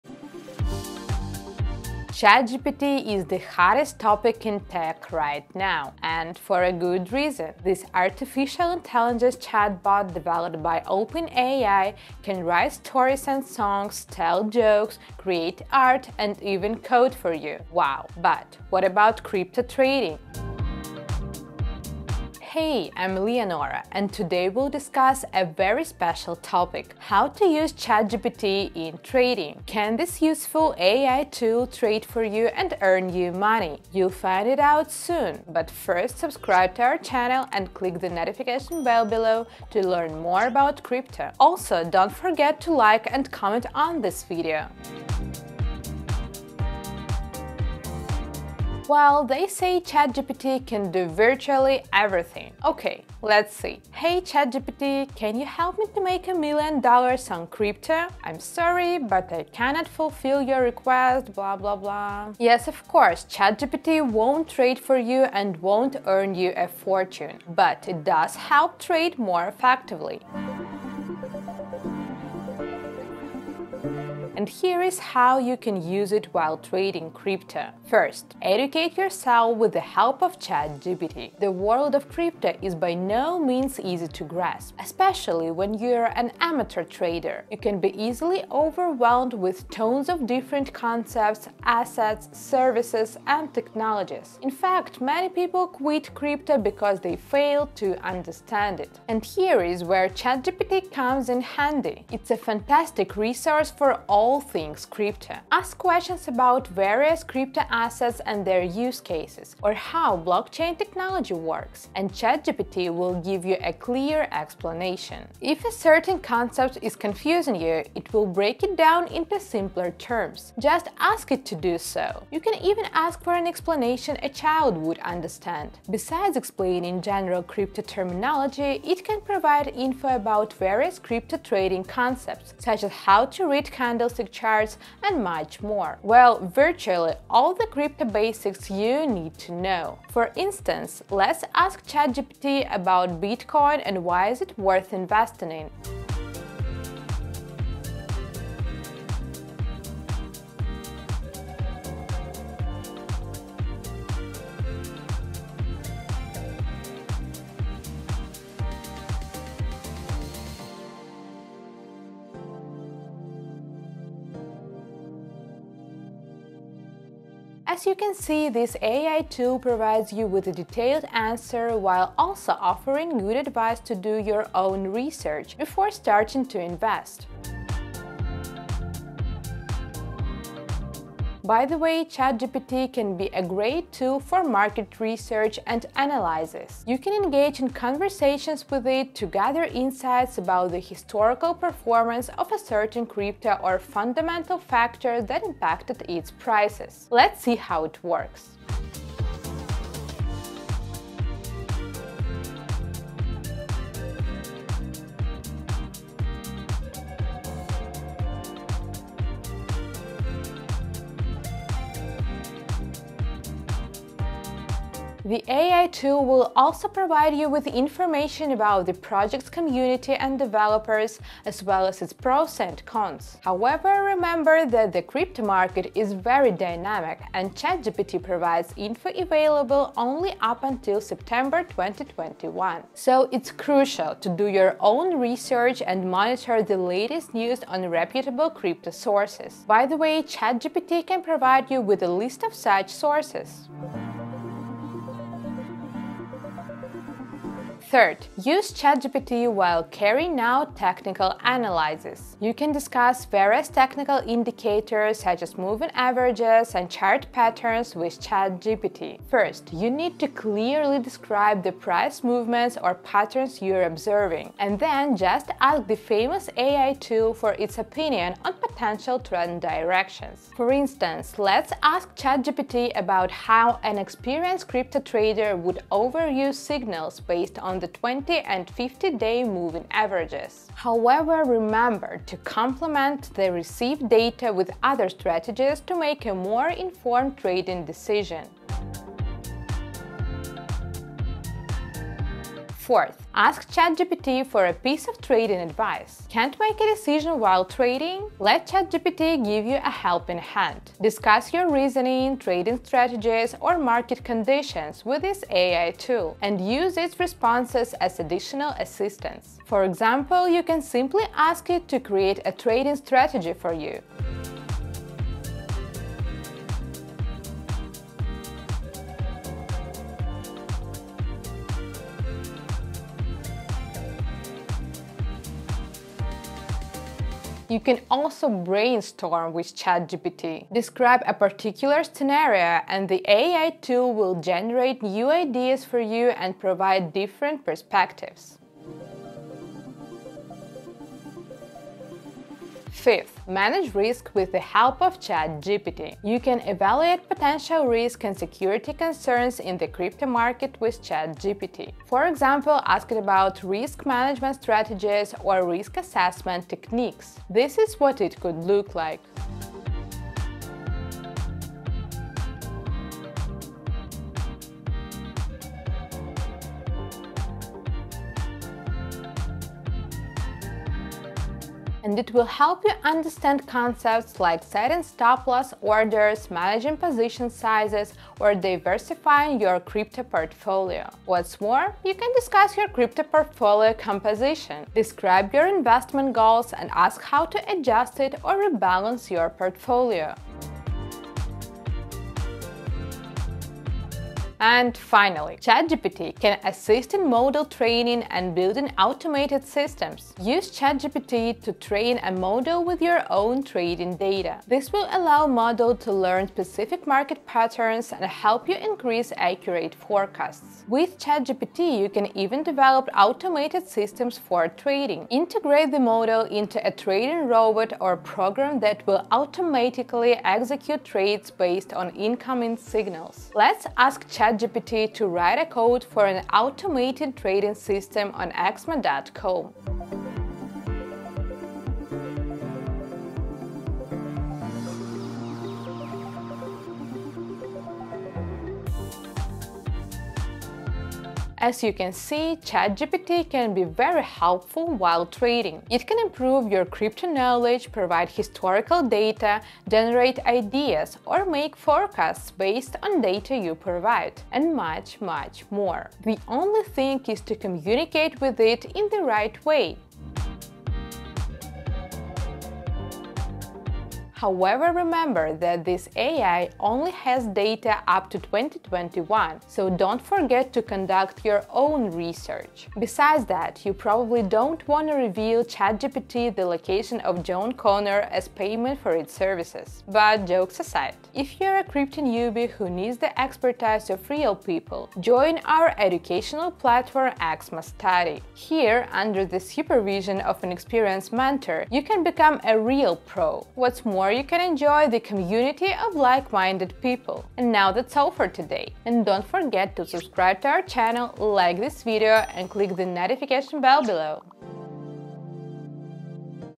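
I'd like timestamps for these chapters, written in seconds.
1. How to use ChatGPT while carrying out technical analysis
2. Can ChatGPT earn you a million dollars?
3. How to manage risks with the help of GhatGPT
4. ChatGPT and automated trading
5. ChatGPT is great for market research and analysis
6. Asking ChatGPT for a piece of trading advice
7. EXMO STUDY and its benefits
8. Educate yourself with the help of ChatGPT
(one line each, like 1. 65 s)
1. 243 s
2. 44 s
3. 338 s
4. 390 s
5. 177 s
6. 288 s
7. 460 s
8. 70 s.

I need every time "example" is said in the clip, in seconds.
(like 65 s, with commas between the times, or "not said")
309 s, 352 s.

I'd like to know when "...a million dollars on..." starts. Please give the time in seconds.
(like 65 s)
56 s.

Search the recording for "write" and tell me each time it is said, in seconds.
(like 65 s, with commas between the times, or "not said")
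12 s, 425 s.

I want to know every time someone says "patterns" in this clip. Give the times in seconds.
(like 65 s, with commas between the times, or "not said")
257 s, 262 s, 407 s.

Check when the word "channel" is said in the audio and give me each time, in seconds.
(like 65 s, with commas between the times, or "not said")
36 s, 500 s.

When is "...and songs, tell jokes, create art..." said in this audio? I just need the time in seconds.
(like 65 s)
13 s.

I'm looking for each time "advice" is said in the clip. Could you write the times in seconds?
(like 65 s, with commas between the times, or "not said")
173 s, 295 s.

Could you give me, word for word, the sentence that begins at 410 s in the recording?
With ChatGPT, you can even develop automated systems for trading.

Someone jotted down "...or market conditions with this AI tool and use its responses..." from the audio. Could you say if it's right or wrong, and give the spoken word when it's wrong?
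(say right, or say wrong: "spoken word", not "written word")
right.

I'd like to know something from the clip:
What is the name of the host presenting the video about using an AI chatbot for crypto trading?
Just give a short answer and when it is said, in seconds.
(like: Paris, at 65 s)
Leonora, at 23 s.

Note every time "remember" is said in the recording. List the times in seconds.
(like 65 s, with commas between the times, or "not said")
224 s, 281 s, 464 s.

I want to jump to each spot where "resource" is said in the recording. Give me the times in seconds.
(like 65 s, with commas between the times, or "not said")
103 s.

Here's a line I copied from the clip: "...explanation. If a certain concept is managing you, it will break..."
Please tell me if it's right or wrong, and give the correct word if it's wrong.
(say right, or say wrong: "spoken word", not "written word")
wrong: "confusing", not "managing".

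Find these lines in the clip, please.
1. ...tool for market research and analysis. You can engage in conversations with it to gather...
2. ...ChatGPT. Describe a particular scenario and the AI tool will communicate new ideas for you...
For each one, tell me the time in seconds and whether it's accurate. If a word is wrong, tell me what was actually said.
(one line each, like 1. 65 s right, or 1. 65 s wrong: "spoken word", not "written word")
1. 183 s right
2. 329 s wrong: "generate", not "communicate".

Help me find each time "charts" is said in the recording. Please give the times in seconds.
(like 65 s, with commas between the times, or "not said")
134 s, 256 s.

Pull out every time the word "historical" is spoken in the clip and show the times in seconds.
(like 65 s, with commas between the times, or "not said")
190 s, 448 s.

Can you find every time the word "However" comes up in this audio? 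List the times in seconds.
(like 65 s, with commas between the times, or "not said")
223 s, 280 s, 464 s.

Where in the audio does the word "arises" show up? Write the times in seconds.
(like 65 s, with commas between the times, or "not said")
not said.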